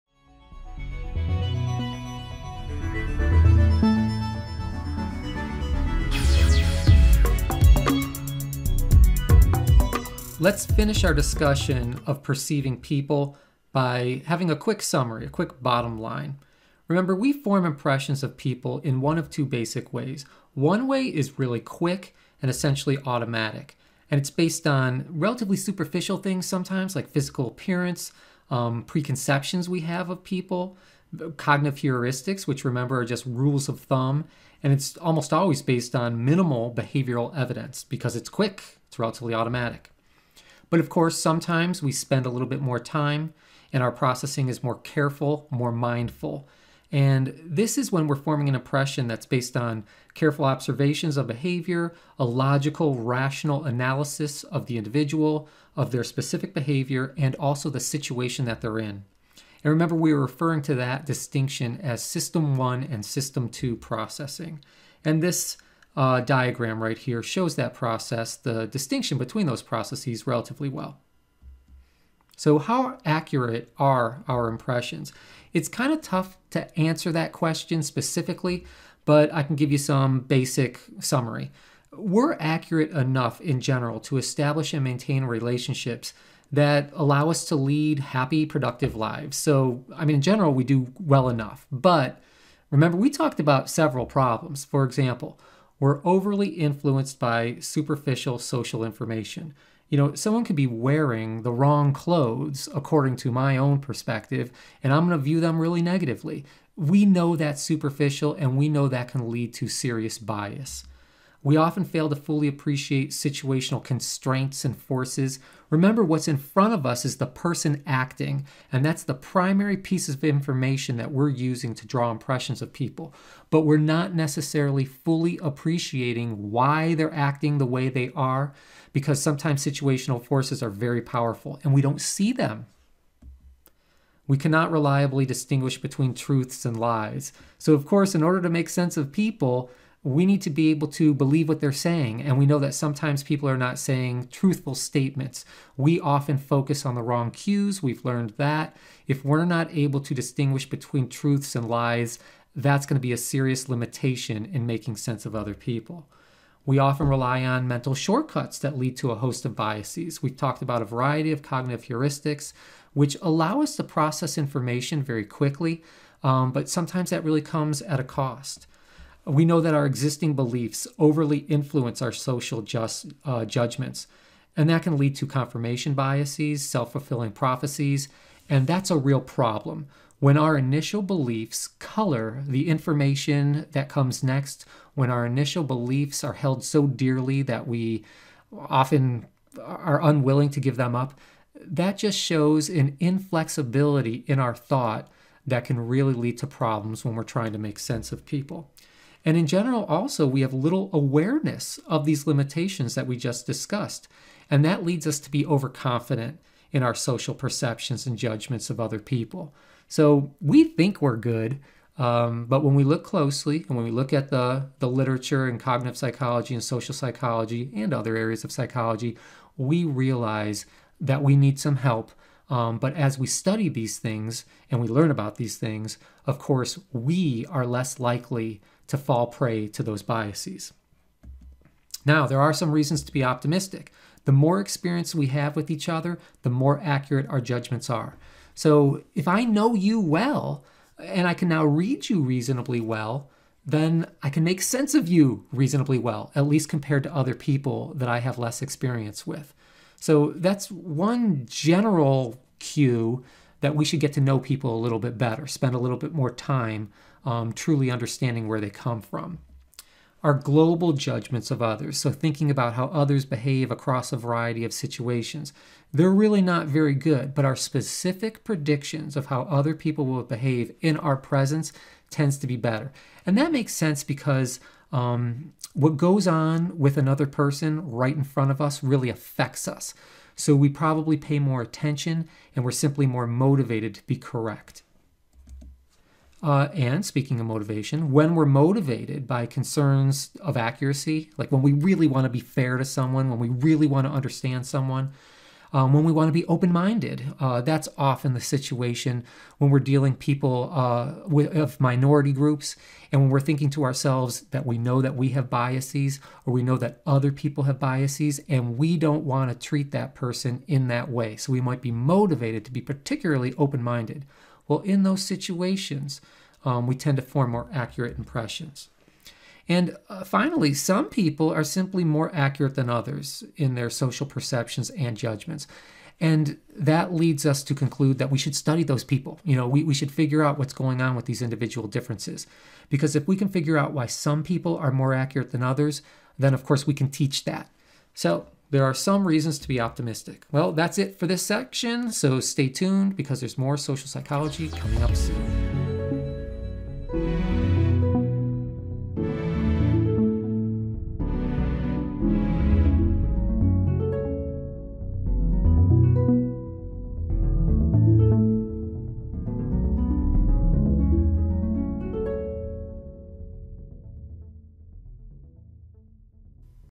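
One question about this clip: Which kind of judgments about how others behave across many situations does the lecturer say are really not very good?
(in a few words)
global judgments.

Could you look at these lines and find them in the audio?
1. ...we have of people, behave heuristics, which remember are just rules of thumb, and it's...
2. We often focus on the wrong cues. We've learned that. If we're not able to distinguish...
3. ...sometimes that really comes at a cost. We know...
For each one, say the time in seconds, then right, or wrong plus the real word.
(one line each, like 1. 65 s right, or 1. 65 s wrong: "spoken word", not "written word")
1. 29 s wrong: "cognitive", not "behave"
2. 145 s right
3. 166 s right.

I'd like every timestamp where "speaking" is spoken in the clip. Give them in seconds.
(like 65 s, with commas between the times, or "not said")
287 s.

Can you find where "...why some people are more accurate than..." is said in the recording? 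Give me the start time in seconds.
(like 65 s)
333 s.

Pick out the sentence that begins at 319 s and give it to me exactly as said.
And uh, finally, some people are simply more accurate than others in their social perceptions and judgments.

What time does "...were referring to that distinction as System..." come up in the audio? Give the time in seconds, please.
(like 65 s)
60 s.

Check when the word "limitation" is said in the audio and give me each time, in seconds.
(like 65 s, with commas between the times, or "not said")
153 s, 202 s.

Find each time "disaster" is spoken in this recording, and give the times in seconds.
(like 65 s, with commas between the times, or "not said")
not said.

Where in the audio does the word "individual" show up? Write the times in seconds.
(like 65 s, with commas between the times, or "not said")
54 s, 331 s.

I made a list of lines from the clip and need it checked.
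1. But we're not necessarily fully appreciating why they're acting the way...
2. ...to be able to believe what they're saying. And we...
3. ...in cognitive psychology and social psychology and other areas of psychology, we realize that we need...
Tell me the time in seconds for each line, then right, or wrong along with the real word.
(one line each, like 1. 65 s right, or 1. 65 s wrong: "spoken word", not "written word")
1. 123 s right
2. 140 s right
3. 215 s right.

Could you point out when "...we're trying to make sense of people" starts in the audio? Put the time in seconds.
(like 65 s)
197 s.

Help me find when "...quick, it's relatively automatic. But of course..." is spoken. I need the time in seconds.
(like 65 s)
38 s.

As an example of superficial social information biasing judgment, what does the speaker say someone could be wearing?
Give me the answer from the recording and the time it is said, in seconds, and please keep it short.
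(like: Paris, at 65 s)
the wrong clothes, at 101 s.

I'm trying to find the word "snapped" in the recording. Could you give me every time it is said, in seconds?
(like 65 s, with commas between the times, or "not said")
not said.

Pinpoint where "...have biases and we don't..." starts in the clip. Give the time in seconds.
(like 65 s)
307 s.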